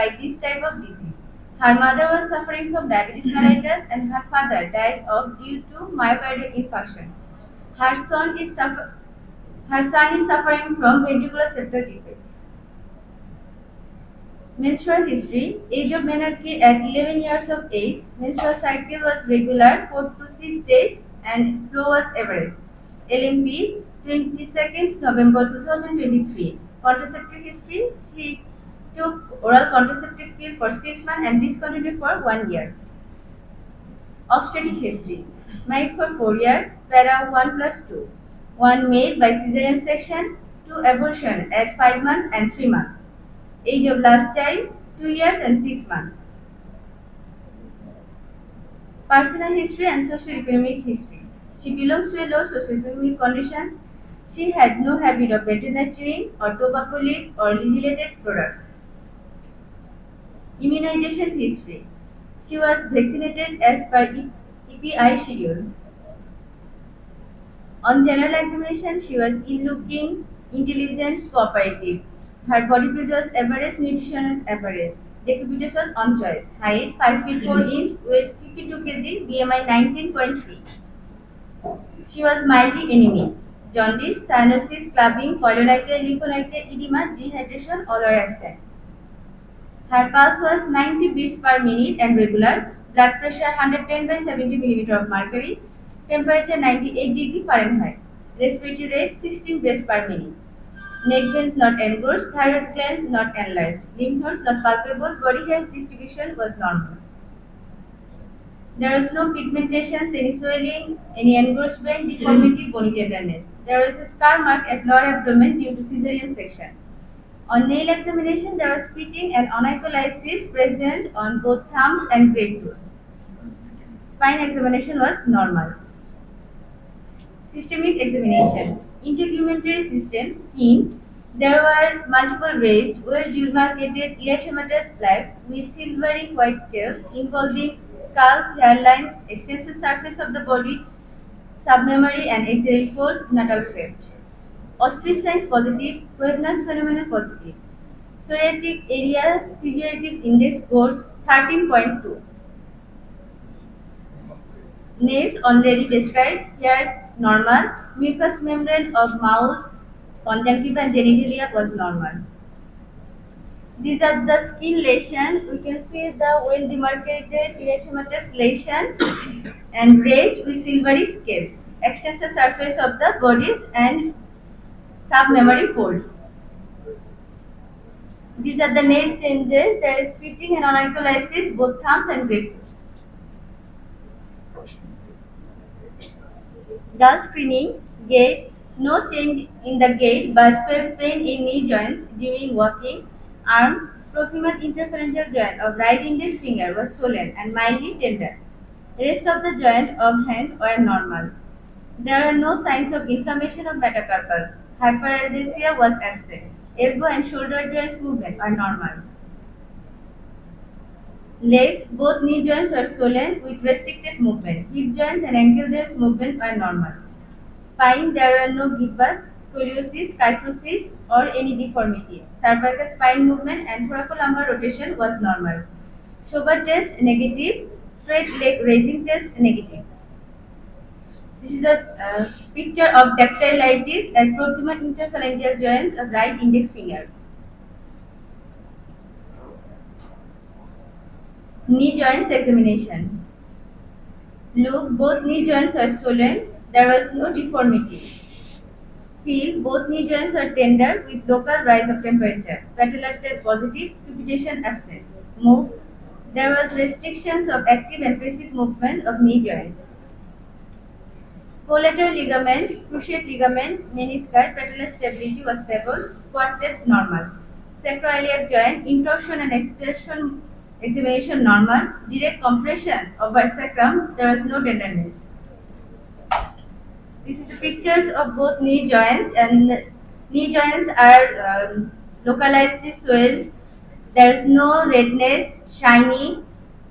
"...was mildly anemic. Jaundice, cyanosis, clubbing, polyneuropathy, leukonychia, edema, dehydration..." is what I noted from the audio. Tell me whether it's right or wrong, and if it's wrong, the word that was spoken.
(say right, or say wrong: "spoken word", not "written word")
right.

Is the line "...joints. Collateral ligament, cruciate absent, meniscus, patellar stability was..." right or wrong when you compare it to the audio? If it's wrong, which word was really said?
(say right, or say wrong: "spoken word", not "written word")
wrong: "ligament", not "absent".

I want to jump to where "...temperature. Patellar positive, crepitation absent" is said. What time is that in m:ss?
4:12.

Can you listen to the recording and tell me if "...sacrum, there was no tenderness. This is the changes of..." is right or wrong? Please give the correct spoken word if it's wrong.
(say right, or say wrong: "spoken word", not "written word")
wrong: "pictures", not "changes".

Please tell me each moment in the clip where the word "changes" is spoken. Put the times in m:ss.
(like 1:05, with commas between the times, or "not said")
2:59, 3:09.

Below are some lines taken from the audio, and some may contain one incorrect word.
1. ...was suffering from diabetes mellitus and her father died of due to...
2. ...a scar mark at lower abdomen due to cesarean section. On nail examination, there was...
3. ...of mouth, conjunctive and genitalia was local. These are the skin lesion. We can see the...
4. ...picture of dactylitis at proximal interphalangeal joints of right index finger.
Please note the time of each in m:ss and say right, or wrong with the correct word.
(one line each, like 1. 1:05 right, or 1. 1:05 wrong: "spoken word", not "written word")
1. 0:02 right
2. 1:53 right
3. 2:38 wrong: "normal", not "local"
4. 3:52 right.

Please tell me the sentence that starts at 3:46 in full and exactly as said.
Schober test negative, straight leg raising test negative.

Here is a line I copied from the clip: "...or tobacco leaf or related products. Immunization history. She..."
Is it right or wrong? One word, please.
right.